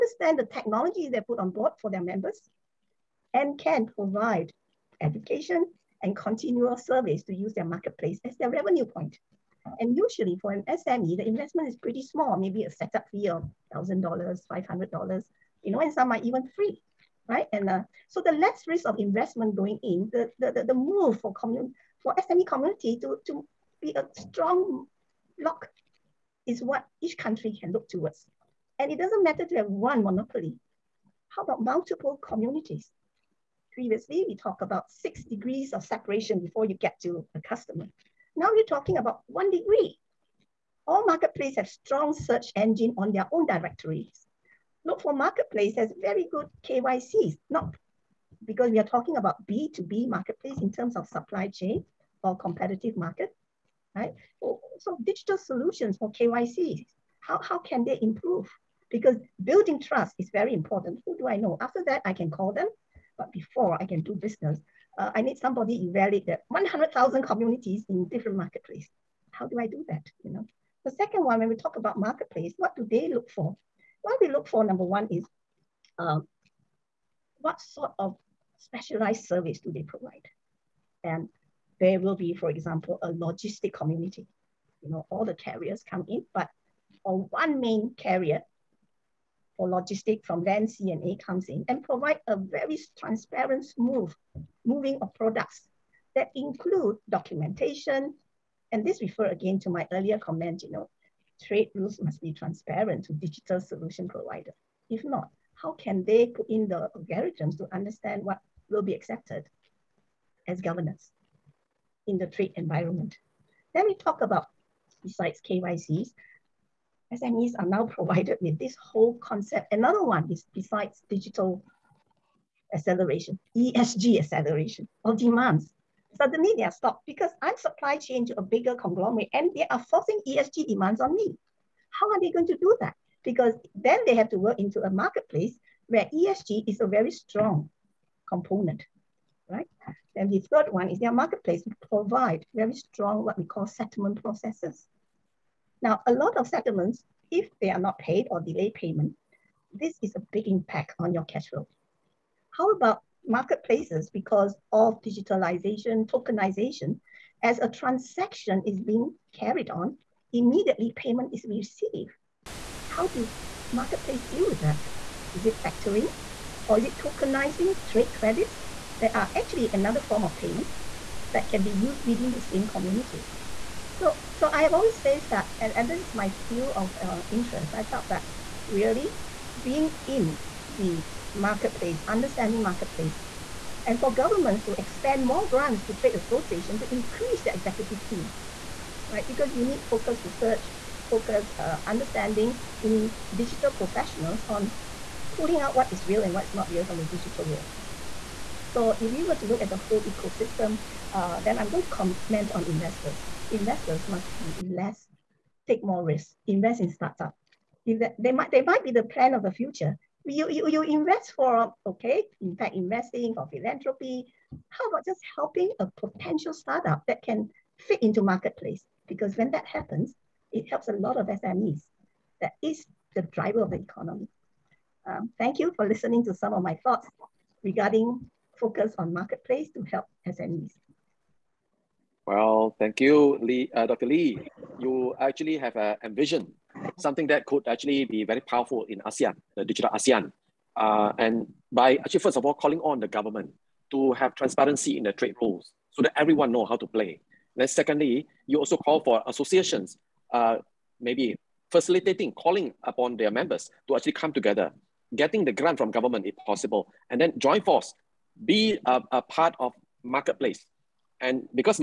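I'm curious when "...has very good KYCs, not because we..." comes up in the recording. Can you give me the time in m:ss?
0:45.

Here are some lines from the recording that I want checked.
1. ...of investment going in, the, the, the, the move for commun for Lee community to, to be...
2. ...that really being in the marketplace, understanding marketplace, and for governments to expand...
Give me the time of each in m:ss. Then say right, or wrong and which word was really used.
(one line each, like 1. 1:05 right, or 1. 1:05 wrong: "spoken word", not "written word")
1. 0:18 wrong: "SME", not "Lee"
2. 2:58 right.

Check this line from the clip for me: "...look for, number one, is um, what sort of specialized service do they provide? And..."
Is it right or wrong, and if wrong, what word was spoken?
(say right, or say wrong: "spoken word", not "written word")
right.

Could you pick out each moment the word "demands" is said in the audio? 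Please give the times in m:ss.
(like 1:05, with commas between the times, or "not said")
2:05, 2:10.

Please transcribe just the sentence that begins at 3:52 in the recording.
Well, thank you, Lee, uh, Dr.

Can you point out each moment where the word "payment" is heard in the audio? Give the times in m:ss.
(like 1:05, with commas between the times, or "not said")
2:28, 2:40, 2:50.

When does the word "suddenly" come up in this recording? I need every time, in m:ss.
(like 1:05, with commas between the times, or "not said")
2:06.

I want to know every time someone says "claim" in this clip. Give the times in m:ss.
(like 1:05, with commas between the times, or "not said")
not said.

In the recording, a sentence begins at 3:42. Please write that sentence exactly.
That is the driver of the economy.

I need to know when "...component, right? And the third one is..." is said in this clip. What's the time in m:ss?
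2:18.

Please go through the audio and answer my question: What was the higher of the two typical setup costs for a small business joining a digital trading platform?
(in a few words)
$1,000.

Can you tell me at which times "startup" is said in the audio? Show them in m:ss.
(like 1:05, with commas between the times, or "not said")
3:26, 3:36.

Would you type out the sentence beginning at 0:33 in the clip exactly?
Previously, we talked about six degrees of separation before you get to a customer.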